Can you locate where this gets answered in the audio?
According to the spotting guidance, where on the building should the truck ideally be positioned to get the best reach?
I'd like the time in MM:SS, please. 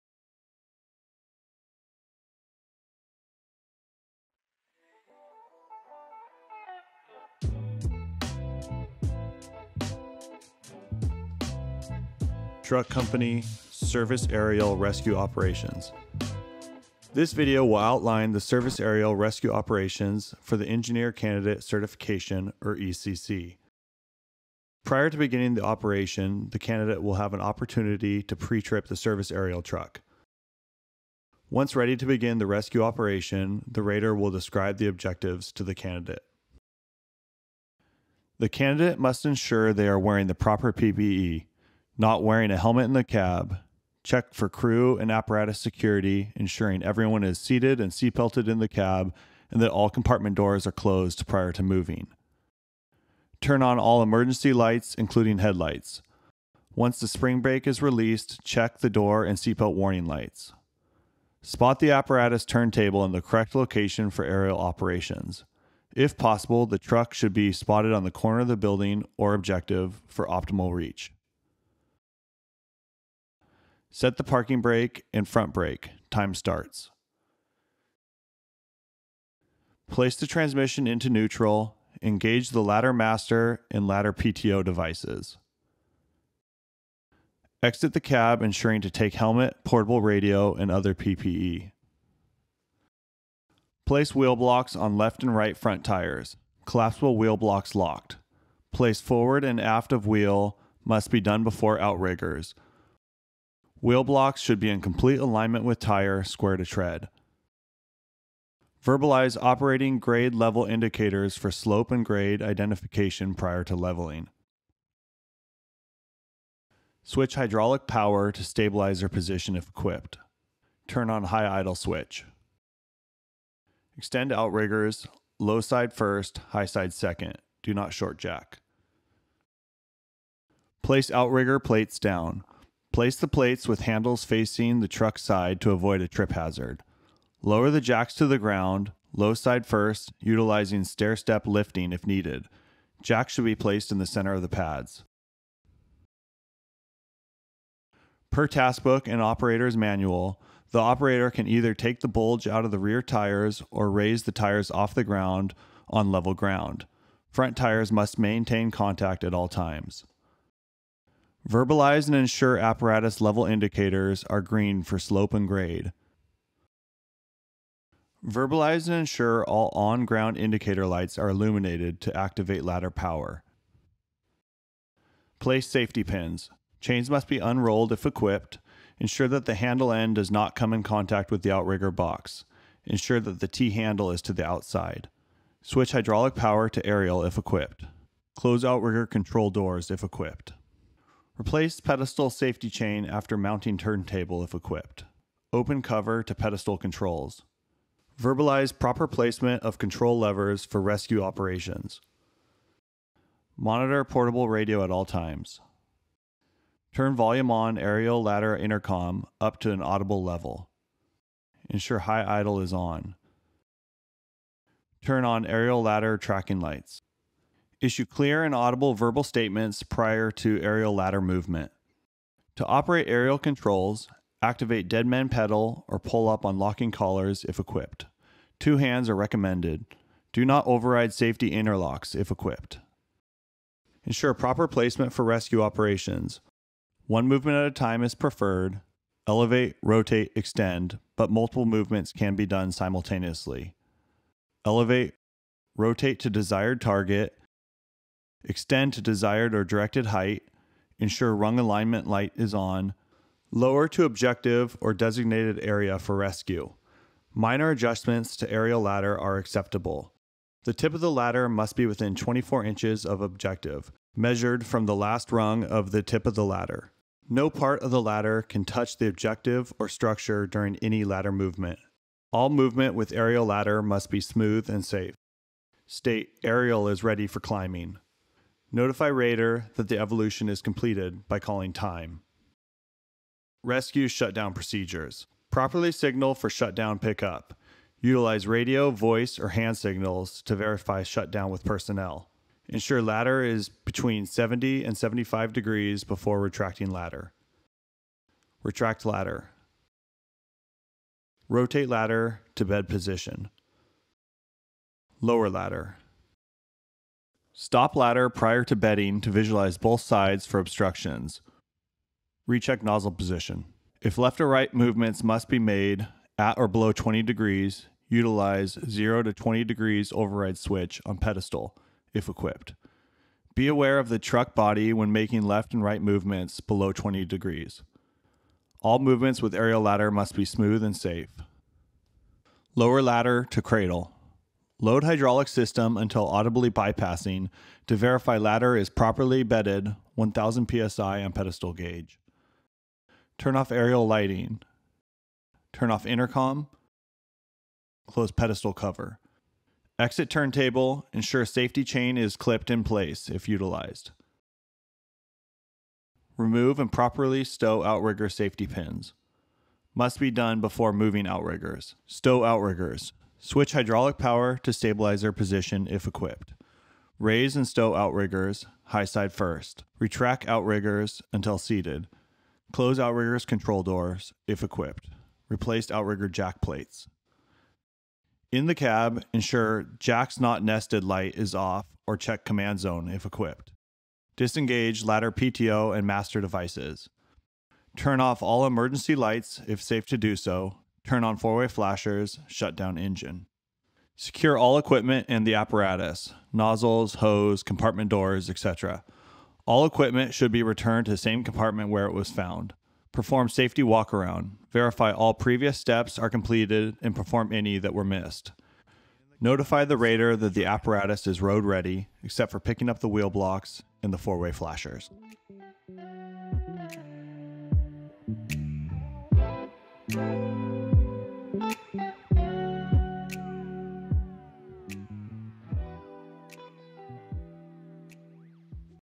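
01:07.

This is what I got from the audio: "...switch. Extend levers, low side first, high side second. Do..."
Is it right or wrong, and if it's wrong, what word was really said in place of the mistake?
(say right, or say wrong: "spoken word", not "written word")
wrong: "outriggers", not "levers".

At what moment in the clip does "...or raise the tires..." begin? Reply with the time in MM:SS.
02:33.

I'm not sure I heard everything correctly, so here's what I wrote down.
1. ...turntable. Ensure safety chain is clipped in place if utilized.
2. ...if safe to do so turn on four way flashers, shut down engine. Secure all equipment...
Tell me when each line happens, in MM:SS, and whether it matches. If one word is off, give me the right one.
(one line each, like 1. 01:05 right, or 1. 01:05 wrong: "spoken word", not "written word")
1. 05:50 right
2. 06:29 right.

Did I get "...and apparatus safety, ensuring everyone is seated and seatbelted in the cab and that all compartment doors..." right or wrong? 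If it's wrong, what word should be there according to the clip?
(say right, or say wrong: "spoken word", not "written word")
wrong: "security", not "safety".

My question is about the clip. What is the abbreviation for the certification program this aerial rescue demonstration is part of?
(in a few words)
ECC.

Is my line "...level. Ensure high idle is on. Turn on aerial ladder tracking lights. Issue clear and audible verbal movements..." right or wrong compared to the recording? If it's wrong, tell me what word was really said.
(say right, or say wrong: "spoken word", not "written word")
wrong: "statements", not "movements".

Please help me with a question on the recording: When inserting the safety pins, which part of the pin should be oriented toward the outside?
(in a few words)
T-handle.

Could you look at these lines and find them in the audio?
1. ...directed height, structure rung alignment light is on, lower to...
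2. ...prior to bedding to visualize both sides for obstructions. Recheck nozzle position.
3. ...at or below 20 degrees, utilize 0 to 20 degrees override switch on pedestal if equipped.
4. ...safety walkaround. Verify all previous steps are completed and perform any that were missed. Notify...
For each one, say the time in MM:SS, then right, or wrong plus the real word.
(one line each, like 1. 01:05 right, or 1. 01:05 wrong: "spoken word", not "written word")
1. 04:09 wrong: "ensure", not "structure"
2. 05:08 right
3. 05:16 right
4. 06:43 right.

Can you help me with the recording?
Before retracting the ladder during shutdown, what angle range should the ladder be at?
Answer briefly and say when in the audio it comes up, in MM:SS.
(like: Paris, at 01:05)
70 to 75 degrees, at 04:53.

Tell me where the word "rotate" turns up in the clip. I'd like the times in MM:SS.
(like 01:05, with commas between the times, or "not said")
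03:59, 04:05, 05:01.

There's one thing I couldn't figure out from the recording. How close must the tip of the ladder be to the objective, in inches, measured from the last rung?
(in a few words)
24 inches.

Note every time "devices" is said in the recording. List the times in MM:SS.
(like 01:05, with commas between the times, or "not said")
01:24, 06:26.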